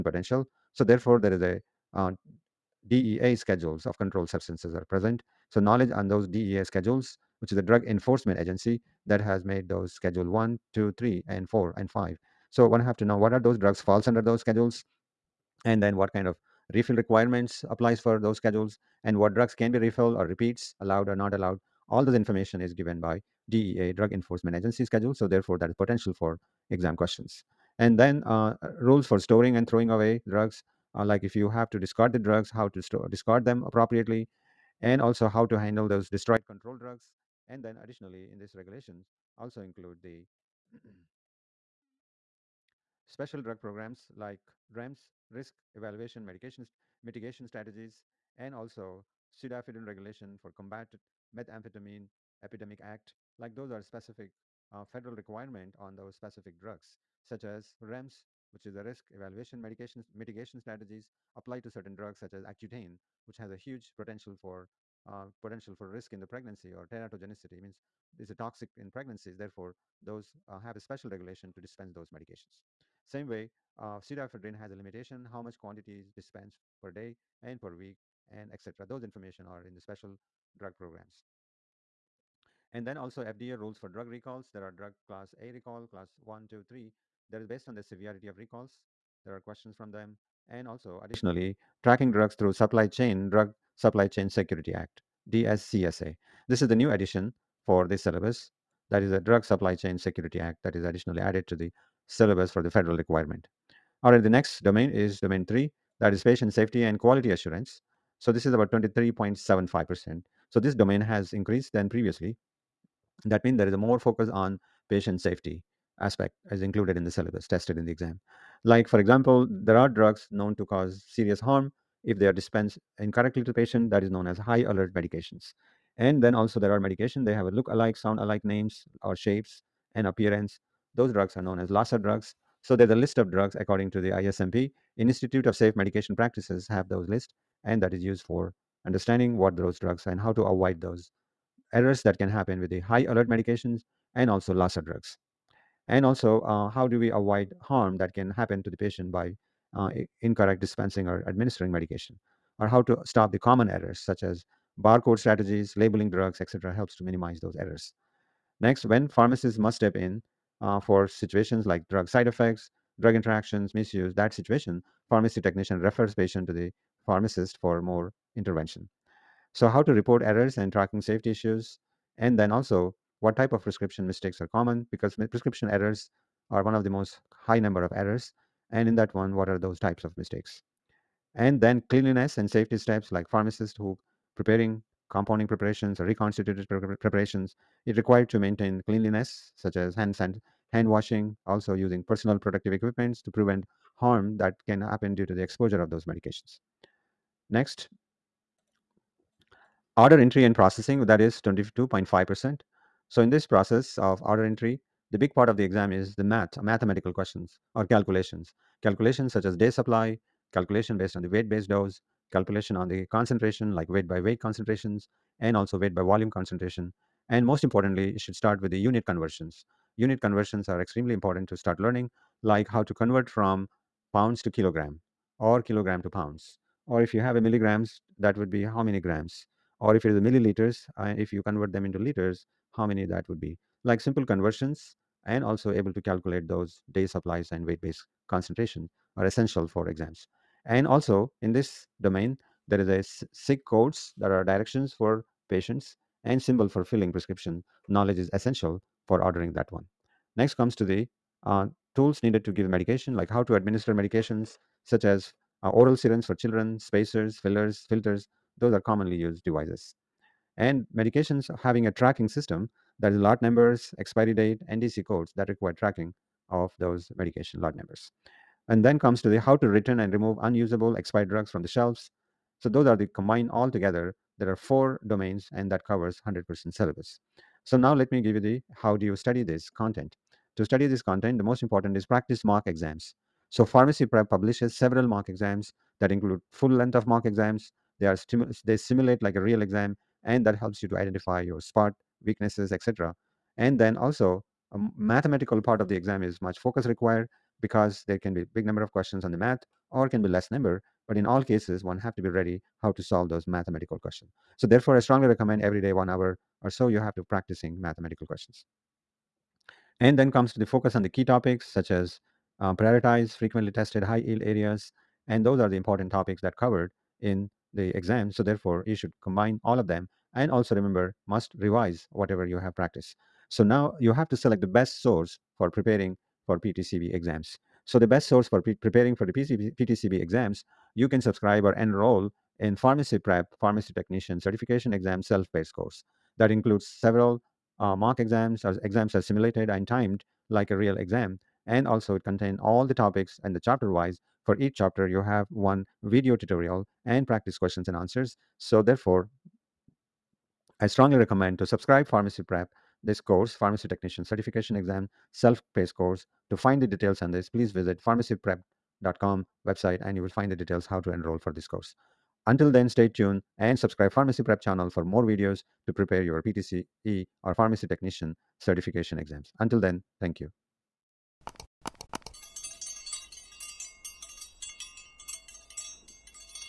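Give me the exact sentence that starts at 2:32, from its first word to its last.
or how to stop the common errors such as barcode strategies, labeling drugs, etc., helps to minimize those errors.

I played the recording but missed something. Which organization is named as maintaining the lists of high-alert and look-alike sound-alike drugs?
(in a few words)
Institute of Safe Medication Practices.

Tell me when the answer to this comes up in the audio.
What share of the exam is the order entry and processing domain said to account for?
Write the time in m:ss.
3:21.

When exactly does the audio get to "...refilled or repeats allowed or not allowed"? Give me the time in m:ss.
0:19.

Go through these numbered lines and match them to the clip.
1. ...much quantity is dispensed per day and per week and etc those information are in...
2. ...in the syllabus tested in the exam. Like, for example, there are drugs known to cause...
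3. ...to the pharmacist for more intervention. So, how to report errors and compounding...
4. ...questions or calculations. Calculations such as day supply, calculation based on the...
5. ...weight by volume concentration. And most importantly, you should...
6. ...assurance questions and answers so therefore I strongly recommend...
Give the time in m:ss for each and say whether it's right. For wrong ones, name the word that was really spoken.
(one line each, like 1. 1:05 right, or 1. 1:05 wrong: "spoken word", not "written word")
1. 1:15 right
2. 1:56 right
3. 2:46 wrong: "tracking", not "compounding"
4. 3:27 right
5. 3:35 right
6. 5:47 wrong: "practice", not "assurance".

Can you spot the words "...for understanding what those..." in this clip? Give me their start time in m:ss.
2:18.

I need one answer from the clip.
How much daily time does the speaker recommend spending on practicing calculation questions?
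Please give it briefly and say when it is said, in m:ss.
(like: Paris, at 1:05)
1 hour, at 5:05.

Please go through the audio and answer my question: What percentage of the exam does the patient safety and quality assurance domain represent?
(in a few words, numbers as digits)
23.75%.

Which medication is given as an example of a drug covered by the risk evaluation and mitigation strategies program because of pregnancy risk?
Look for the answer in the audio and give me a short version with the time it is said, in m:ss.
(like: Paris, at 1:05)
Accutane, at 1:02.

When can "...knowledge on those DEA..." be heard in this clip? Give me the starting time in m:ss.
0:05.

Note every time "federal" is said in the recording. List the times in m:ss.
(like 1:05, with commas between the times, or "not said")
0:54, 1:42.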